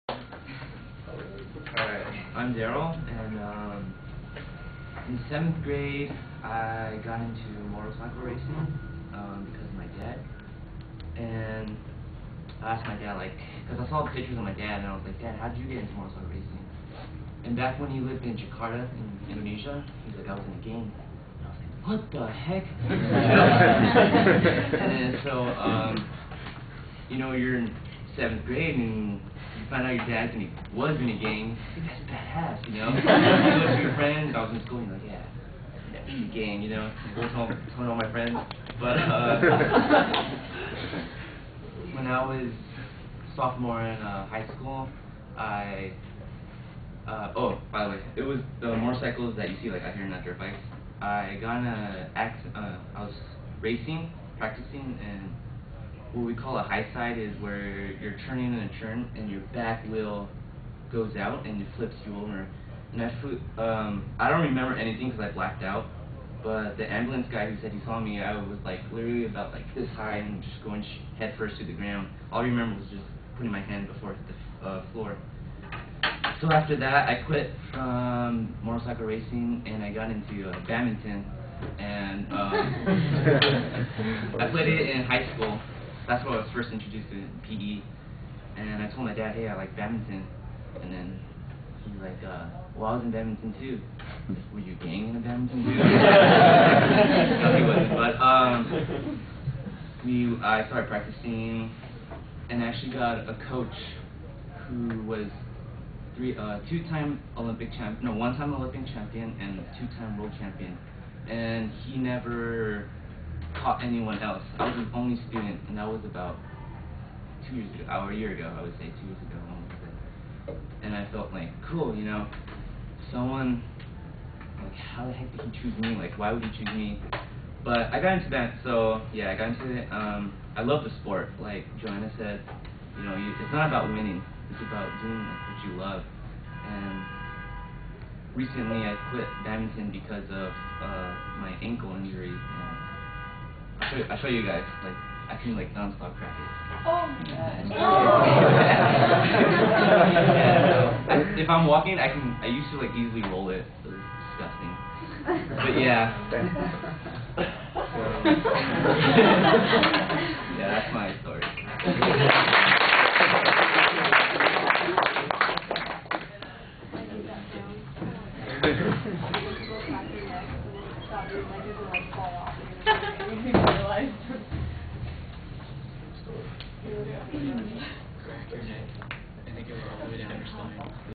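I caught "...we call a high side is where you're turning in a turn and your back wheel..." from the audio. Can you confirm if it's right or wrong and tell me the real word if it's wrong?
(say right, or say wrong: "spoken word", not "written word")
right.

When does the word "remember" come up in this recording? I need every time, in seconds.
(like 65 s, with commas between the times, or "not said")
64 s, 72 s.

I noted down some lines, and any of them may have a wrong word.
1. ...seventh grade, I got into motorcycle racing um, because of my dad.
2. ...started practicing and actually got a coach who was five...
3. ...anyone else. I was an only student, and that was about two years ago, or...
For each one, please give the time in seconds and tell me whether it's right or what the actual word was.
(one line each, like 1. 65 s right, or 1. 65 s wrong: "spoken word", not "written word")
1. 5 s right
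2. 100 s wrong: "three", not "five"
3. 113 s right.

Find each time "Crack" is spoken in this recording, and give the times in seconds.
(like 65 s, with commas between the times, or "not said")
178 s.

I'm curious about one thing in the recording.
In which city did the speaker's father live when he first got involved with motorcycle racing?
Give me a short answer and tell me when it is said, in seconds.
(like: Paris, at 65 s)
Jakarta, at 18 s.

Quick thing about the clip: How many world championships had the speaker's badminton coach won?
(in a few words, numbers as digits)
2.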